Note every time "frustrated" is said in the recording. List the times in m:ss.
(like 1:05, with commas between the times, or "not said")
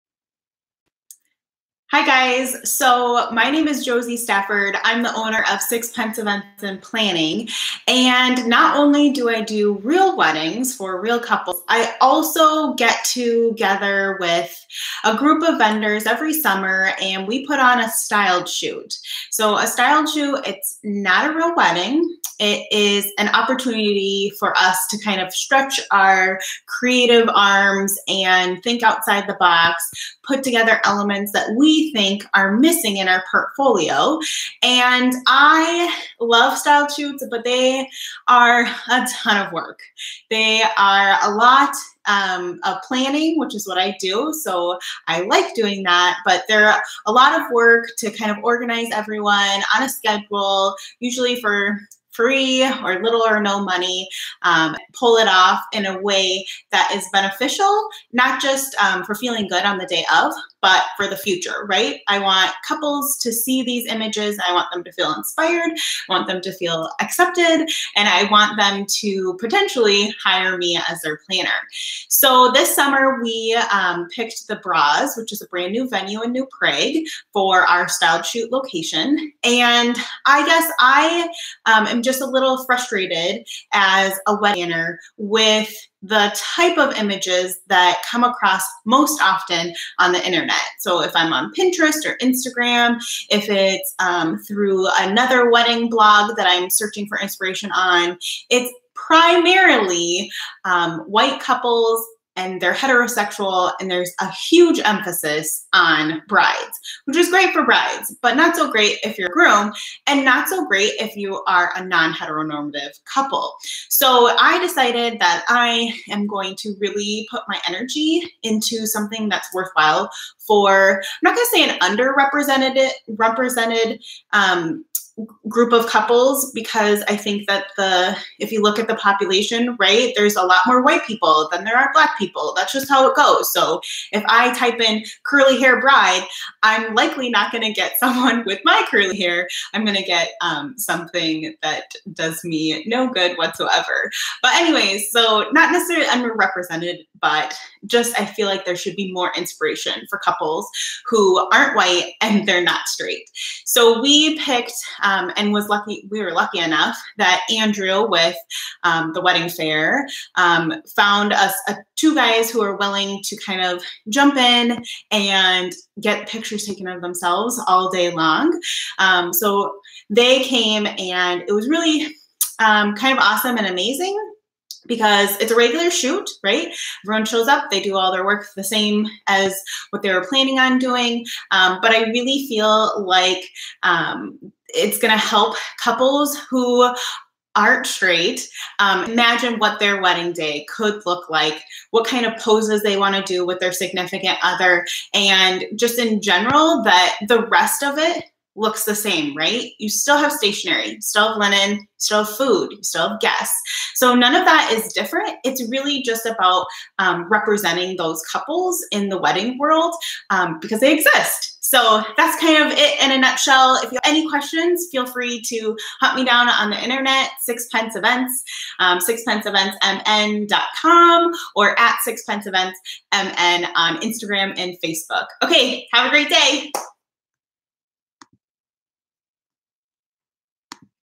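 1:22.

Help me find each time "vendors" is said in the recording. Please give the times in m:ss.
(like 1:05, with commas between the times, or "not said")
0:15.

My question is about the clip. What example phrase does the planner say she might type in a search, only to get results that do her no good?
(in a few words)
curly hair bride.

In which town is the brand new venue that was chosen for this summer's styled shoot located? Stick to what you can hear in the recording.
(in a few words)
New Prague.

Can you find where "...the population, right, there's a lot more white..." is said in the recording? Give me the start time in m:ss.
2:08.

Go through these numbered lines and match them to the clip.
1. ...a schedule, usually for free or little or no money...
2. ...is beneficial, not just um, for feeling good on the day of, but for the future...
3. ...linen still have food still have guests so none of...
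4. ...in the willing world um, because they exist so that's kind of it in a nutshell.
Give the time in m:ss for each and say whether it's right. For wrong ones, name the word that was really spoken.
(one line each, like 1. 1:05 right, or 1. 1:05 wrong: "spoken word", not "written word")
1. 0:49 right
2. 0:56 right
3. 3:21 right
4. 3:28 wrong: "wedding", not "willing".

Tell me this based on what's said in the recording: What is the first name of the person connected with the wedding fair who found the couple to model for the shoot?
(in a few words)
Andrew.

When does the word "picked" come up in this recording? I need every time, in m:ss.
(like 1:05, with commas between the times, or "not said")
1:14, 2:34.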